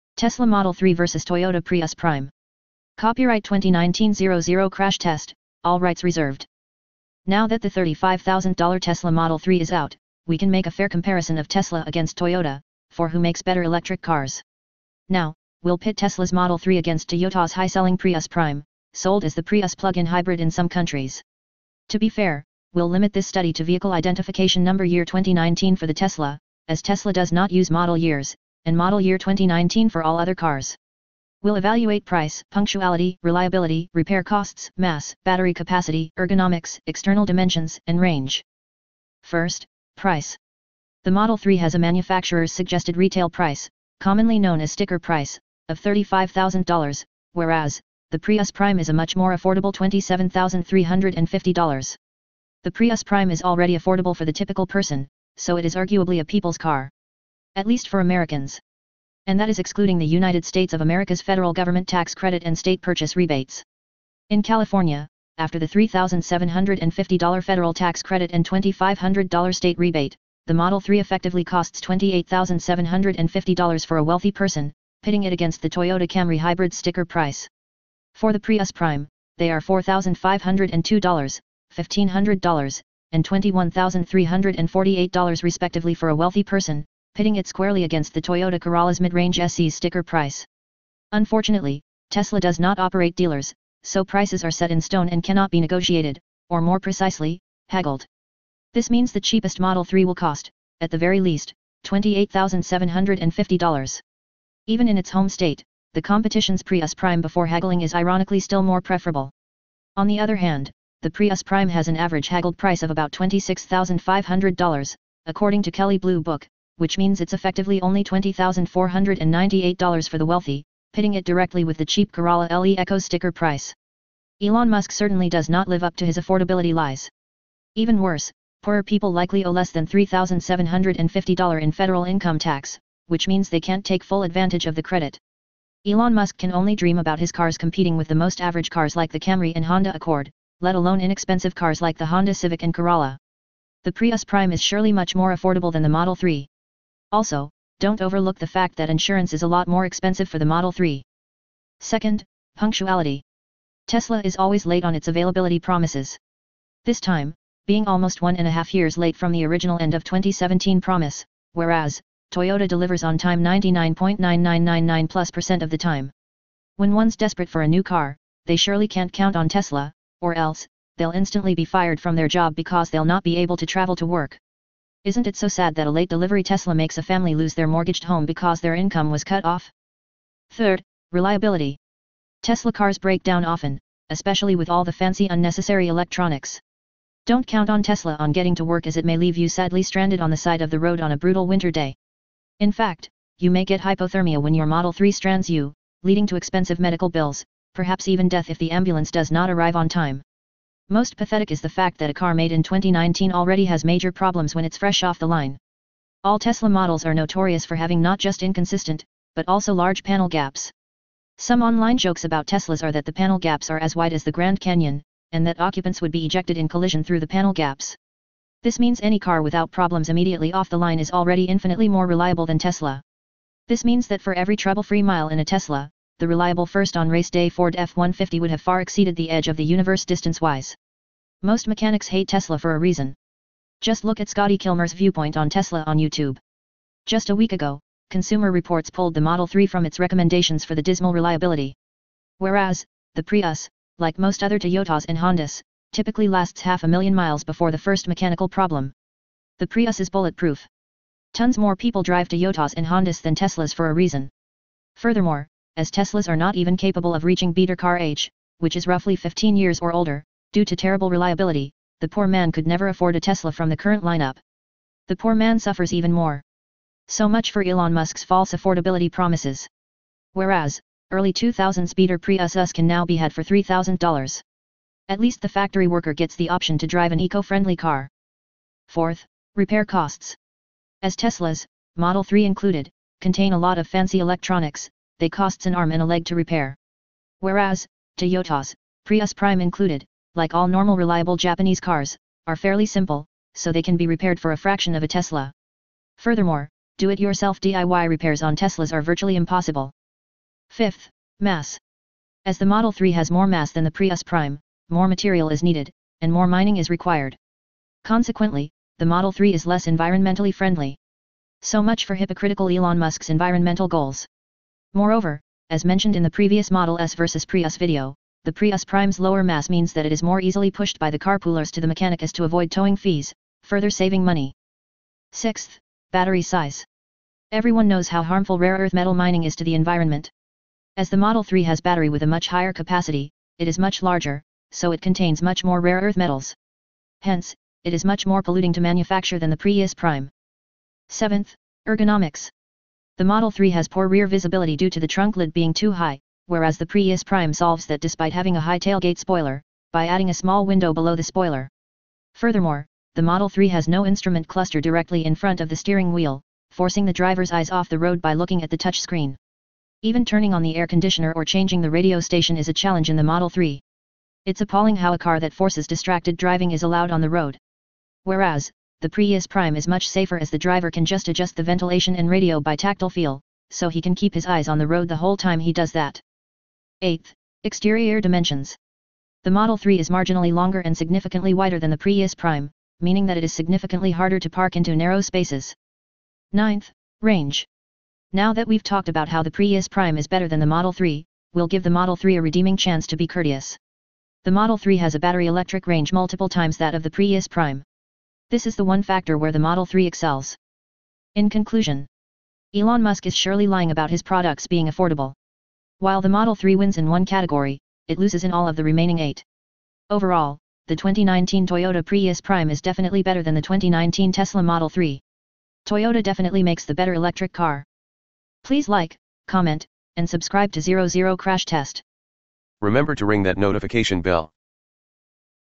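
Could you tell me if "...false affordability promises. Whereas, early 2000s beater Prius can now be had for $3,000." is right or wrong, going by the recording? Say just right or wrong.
right.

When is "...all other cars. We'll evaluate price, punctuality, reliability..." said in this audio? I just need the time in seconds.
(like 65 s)
30 s.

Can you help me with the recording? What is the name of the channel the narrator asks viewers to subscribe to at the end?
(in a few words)
00 Crash Test.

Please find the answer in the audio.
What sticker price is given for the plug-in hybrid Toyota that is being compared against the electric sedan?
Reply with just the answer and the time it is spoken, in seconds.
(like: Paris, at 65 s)
$27,350, at 49 s.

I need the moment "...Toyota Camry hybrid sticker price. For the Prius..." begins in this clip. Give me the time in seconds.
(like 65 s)
75 s.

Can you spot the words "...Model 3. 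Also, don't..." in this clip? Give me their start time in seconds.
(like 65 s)
145 s.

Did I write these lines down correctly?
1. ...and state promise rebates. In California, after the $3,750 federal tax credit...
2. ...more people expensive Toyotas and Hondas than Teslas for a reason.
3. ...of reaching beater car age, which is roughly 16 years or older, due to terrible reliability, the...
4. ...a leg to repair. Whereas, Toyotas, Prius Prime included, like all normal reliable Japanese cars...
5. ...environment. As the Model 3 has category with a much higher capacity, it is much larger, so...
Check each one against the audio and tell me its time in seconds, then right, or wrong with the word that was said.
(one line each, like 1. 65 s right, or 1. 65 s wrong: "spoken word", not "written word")
1. 62 s wrong: "purchase", not "promise"
2. 251 s wrong: "drive", not "expensive"
3. 257 s wrong: "15", not "16"
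4. 286 s right
5. 329 s wrong: "battery", not "category".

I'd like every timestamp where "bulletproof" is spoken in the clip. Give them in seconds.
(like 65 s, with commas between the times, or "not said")
250 s.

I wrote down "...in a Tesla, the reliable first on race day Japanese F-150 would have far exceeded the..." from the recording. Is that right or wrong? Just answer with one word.
wrong.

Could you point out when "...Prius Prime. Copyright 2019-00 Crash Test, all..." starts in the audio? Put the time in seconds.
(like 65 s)
1 s.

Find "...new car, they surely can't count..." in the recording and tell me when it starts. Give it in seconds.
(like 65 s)
167 s.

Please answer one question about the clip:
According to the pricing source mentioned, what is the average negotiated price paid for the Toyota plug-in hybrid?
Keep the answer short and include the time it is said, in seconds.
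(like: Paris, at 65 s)
$26,500, at 113 s.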